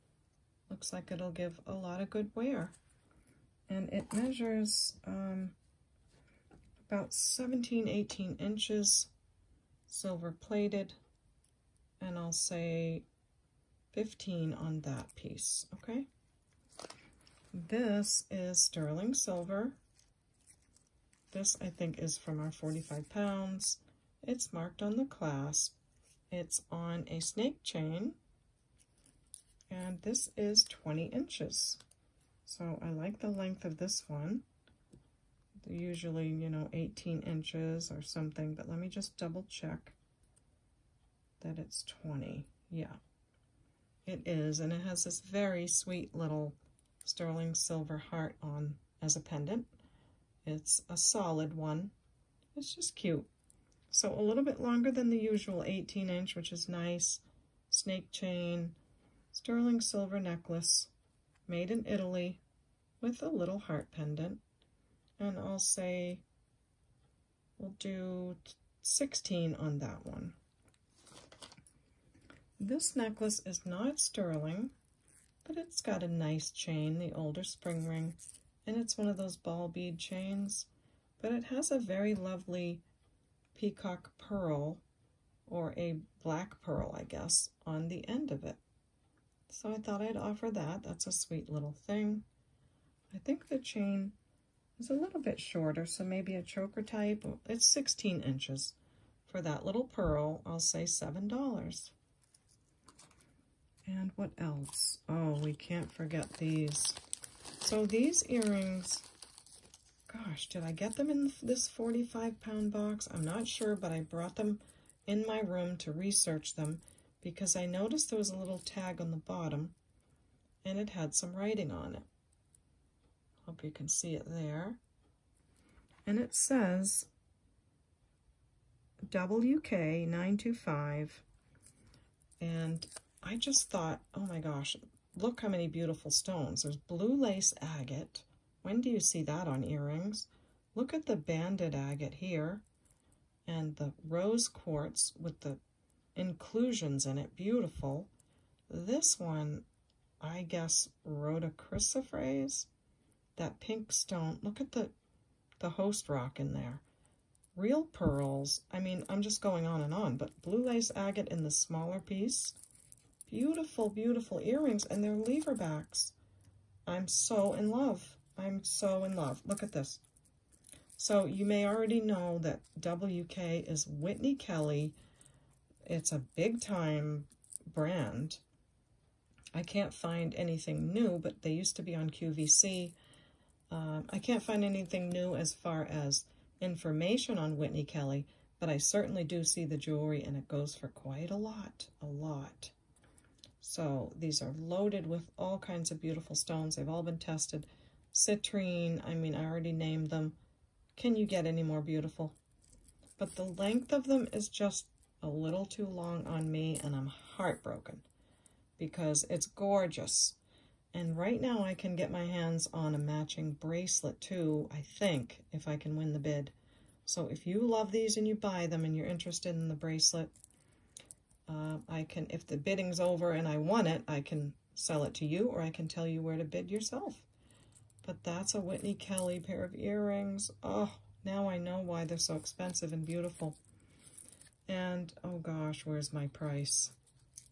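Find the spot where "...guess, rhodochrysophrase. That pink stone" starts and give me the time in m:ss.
2:30.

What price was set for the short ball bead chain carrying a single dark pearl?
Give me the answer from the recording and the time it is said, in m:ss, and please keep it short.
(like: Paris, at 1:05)
$7, at 1:40.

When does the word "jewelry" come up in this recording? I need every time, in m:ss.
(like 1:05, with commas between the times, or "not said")
3:09.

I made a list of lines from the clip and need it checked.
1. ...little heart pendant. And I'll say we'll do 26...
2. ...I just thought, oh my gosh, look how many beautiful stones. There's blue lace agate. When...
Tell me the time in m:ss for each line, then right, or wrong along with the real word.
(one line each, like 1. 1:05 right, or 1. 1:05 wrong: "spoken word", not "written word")
1. 1:03 wrong: "16", not "26"
2. 2:13 right.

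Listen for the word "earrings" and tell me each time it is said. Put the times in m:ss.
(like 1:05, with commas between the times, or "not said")
1:48, 2:19, 2:44, 3:49.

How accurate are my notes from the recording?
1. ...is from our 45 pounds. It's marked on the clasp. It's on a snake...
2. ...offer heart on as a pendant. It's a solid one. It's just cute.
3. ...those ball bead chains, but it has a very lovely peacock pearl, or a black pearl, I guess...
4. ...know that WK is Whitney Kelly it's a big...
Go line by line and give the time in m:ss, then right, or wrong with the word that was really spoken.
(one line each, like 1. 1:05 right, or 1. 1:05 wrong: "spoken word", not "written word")
1. 0:21 right
2. 0:47 wrong: "silver", not "offer"
3. 1:19 right
4. 2:51 right.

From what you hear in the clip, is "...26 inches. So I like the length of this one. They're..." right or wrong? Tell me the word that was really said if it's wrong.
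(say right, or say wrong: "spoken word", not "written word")
wrong: "20", not "26".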